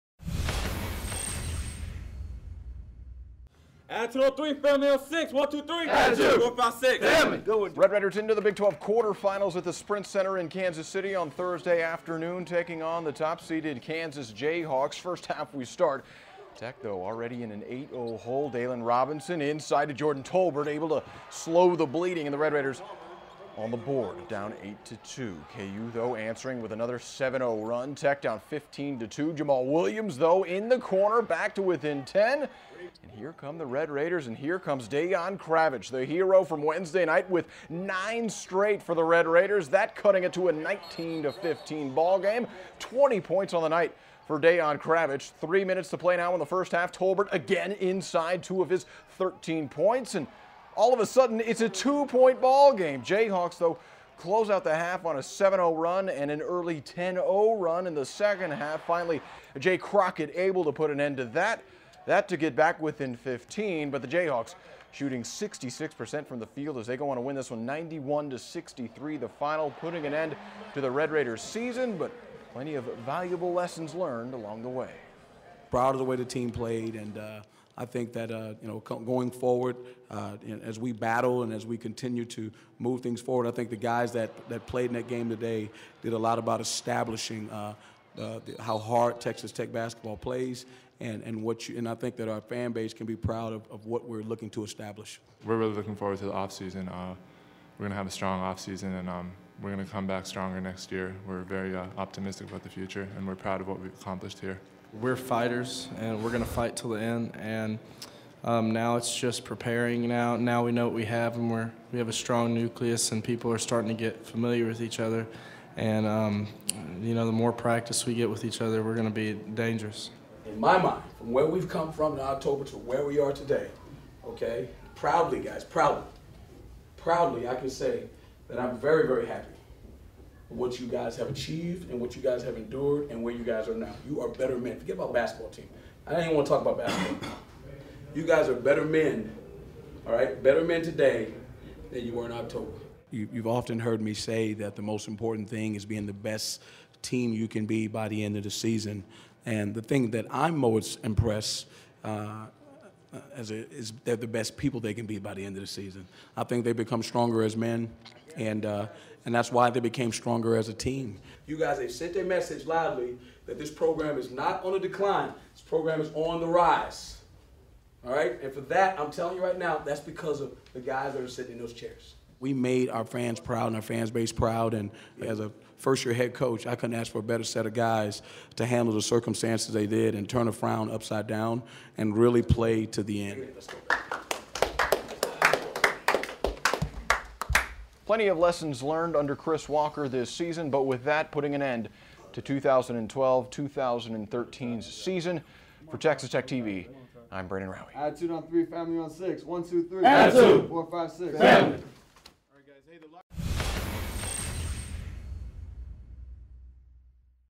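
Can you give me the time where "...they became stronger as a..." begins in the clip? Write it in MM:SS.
02:39.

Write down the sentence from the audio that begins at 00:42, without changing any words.
20 points on the night for Dejan Kravic.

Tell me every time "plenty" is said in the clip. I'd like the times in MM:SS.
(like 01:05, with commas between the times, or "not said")
01:12, 03:08.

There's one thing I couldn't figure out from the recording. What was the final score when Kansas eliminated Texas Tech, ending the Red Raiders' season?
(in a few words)
91-63.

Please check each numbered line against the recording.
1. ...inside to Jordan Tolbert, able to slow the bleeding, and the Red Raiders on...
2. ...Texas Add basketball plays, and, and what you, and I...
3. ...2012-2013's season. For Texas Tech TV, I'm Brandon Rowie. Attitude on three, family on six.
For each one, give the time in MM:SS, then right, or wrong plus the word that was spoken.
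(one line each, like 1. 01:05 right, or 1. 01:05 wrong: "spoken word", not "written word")
1. 00:19 right
2. 01:29 wrong: "Tech", not "Add"
3. 03:12 right.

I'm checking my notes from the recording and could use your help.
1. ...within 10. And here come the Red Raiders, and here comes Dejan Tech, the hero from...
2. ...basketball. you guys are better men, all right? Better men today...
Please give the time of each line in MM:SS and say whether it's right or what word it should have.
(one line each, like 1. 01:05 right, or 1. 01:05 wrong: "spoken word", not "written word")
1. 00:31 wrong: "Kravic", not "Tech"
2. 02:16 right.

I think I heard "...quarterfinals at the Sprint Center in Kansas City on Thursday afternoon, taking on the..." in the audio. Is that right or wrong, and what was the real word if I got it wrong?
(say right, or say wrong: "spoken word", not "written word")
right.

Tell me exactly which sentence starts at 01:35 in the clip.
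We're really looking forward to the offseason.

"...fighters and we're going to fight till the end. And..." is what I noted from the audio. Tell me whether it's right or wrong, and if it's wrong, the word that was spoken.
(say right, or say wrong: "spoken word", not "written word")
right.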